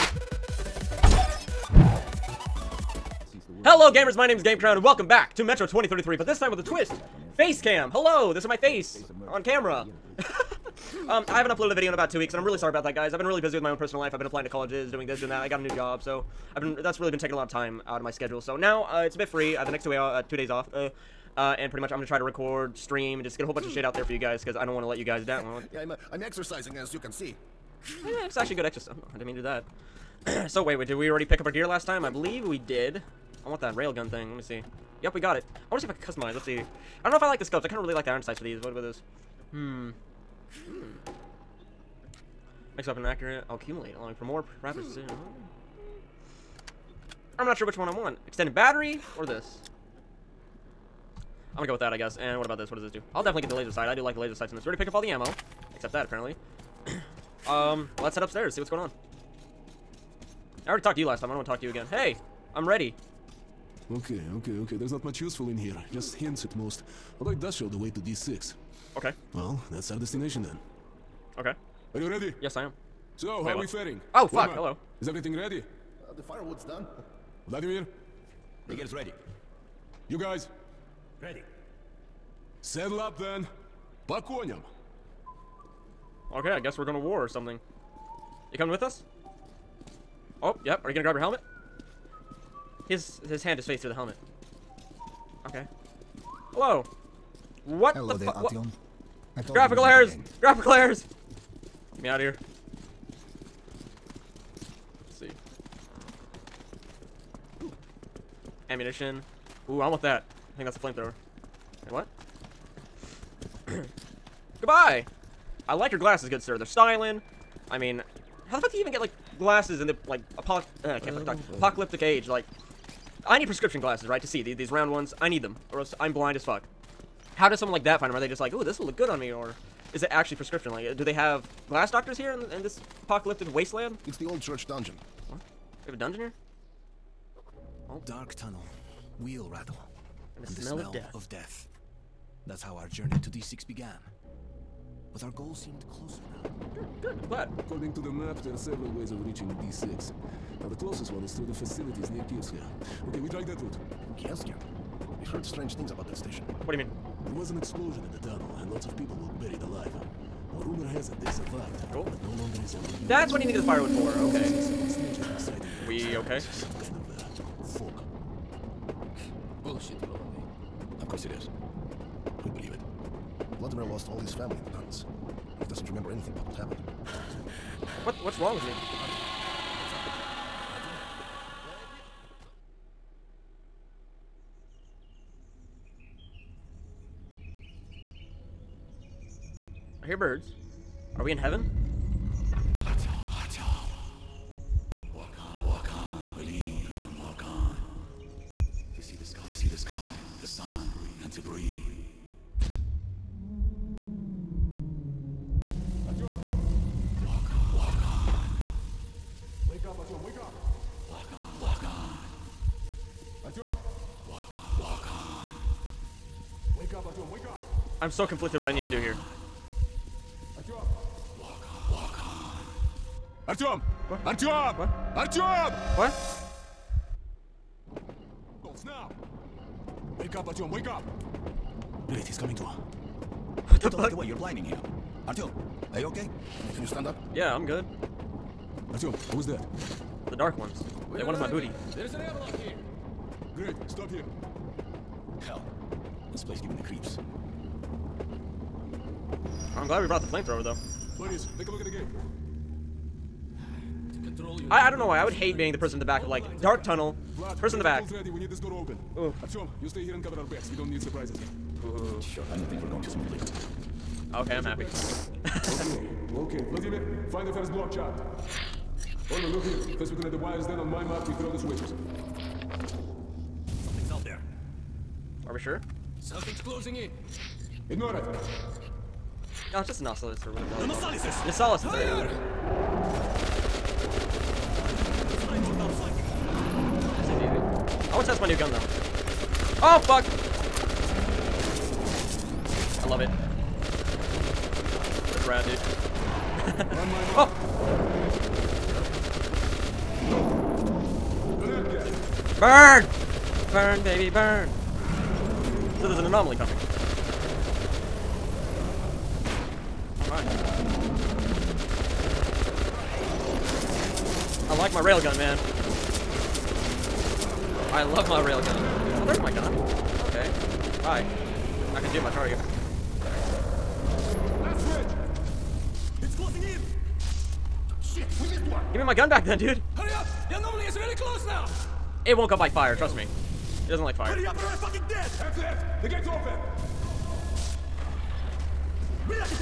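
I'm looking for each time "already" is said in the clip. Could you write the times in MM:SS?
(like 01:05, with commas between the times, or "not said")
00:31, 00:54, 01:00.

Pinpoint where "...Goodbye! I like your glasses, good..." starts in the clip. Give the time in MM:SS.
01:54.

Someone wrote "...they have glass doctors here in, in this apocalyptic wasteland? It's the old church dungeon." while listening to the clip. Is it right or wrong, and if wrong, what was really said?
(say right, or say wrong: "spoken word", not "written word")
right.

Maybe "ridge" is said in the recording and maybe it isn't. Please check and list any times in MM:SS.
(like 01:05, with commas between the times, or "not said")
05:24.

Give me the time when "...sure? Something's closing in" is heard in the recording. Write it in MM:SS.
04:35.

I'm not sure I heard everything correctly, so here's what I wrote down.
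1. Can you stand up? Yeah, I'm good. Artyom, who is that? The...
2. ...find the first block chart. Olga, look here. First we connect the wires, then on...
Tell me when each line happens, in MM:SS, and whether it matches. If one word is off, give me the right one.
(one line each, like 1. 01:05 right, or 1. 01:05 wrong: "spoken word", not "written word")
1. 03:56 right
2. 04:27 right.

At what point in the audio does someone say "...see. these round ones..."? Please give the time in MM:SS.
02:04.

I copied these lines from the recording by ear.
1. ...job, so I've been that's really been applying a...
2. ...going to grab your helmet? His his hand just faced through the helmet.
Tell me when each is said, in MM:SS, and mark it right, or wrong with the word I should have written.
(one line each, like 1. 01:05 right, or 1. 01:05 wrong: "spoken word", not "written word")
1. 00:15 wrong: "taking", not "applying"
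2. 01:30 right.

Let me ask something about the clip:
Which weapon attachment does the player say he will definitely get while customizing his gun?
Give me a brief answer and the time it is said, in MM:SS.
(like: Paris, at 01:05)
Laser sight, at 00:53.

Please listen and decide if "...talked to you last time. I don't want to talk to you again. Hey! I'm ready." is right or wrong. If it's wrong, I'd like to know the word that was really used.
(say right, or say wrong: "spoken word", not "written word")
right.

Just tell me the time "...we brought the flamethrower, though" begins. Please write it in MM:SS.
04:10.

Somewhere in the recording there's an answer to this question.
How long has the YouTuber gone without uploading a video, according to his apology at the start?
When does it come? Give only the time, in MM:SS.
00:11.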